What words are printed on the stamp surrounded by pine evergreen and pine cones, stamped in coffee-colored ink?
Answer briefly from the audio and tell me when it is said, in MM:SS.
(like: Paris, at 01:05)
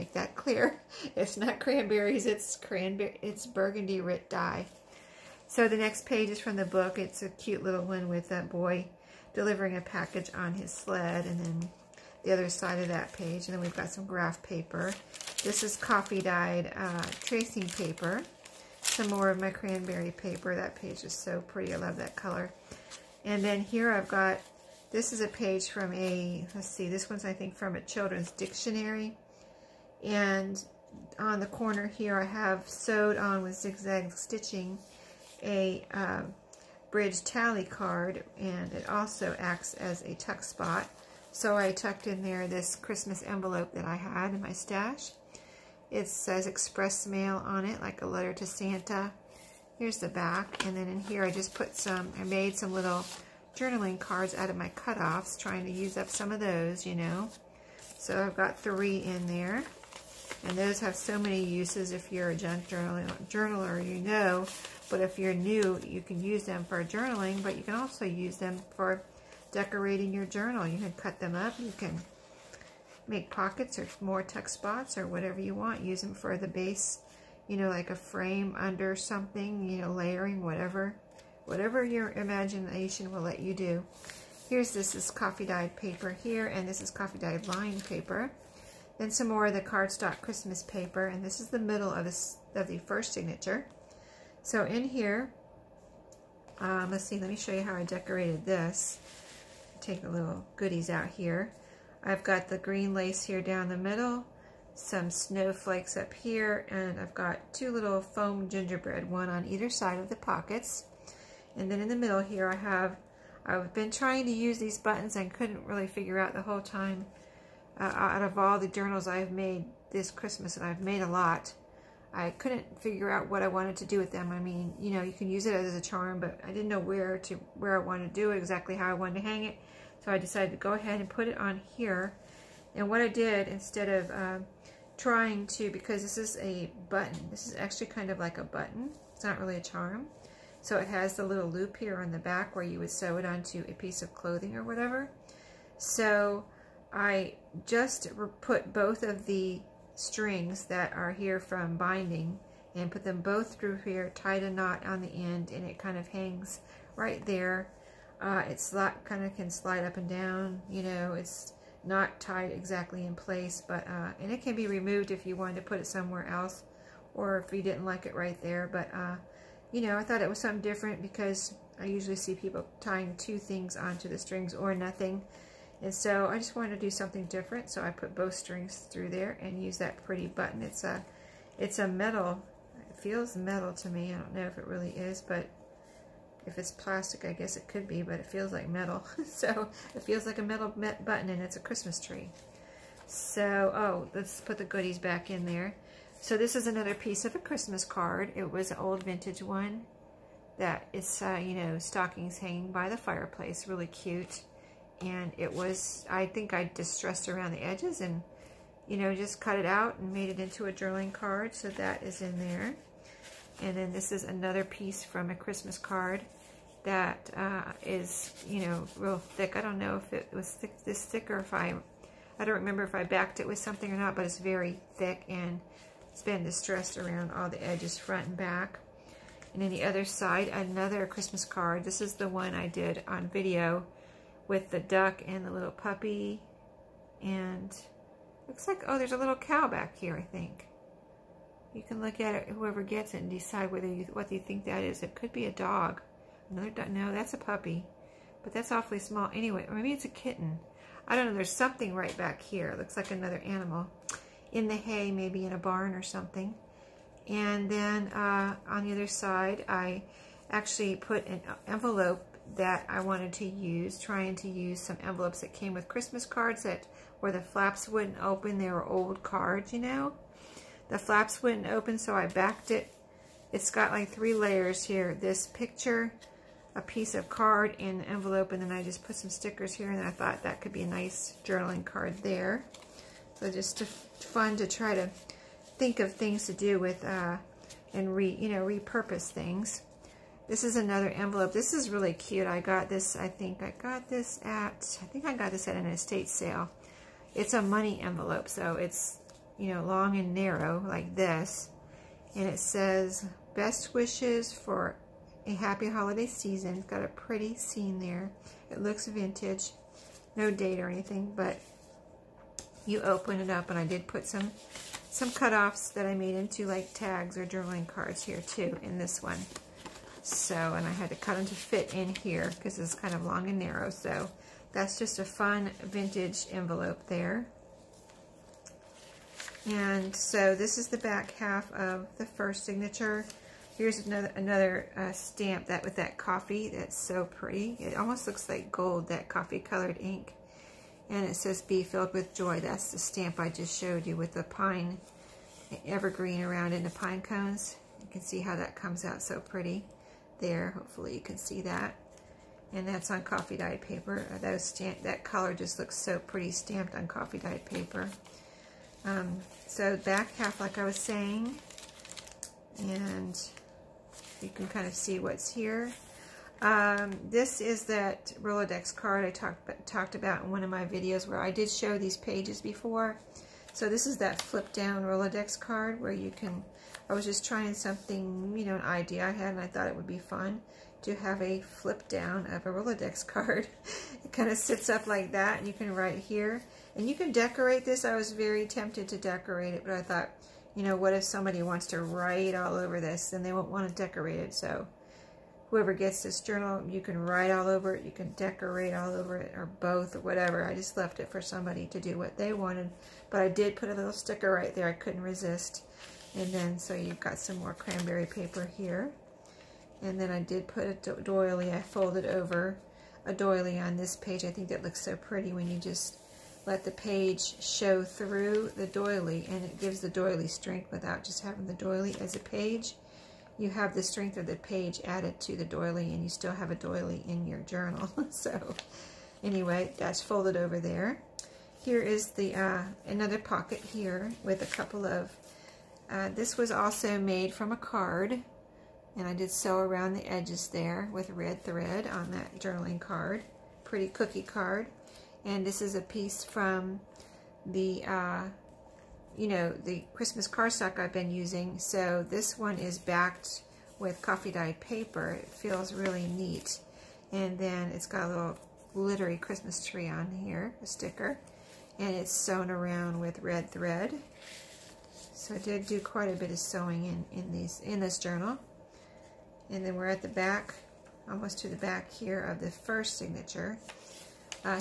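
be filled with joy, at 05:41.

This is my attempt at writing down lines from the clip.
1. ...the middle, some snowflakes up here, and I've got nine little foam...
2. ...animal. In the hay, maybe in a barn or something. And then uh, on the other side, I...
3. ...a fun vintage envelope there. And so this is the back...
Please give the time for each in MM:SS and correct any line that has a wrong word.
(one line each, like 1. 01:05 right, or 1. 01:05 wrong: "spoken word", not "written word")
1. 01:43 wrong: "two", not "nine"
2. 04:13 right
3. 05:25 right.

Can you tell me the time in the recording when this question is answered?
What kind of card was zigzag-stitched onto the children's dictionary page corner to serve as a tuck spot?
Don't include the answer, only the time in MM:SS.
00:36.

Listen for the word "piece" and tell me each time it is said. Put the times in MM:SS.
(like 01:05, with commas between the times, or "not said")
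02:23, 03:16, 03:34, 04:36, 07:26.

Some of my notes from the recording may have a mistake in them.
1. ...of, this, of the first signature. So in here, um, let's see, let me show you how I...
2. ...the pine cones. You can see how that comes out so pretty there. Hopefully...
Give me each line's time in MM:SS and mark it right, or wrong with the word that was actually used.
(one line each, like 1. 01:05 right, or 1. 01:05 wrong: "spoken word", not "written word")
1. 01:31 right
2. 05:46 right.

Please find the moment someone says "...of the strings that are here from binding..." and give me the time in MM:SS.
02:29.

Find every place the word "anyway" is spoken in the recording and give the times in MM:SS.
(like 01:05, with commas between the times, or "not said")
04:09, 07:09.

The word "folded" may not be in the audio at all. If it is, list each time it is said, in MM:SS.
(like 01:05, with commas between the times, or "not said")
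06:51, 07:10.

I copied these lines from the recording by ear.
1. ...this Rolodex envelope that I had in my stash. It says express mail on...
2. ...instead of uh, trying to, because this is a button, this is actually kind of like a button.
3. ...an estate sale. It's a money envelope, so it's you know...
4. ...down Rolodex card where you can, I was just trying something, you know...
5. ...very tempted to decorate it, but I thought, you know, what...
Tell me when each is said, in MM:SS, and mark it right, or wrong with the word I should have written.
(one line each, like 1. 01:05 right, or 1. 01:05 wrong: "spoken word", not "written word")
1. 00:42 wrong: "Christmas", not "Rolodex"
2. 02:13 right
3. 04:55 right
4. 06:14 right
5. 06:28 right.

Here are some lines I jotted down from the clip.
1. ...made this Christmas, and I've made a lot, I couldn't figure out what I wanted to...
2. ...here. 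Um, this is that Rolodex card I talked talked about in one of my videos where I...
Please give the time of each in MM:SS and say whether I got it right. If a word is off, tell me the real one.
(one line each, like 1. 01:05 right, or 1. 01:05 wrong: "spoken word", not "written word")
1. 01:59 right
2. 06:05 right.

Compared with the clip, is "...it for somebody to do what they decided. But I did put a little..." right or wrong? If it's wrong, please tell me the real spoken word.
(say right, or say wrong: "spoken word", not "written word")
wrong: "wanted", not "decided".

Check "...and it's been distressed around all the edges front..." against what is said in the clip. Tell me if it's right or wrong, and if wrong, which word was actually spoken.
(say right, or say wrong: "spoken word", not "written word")
right.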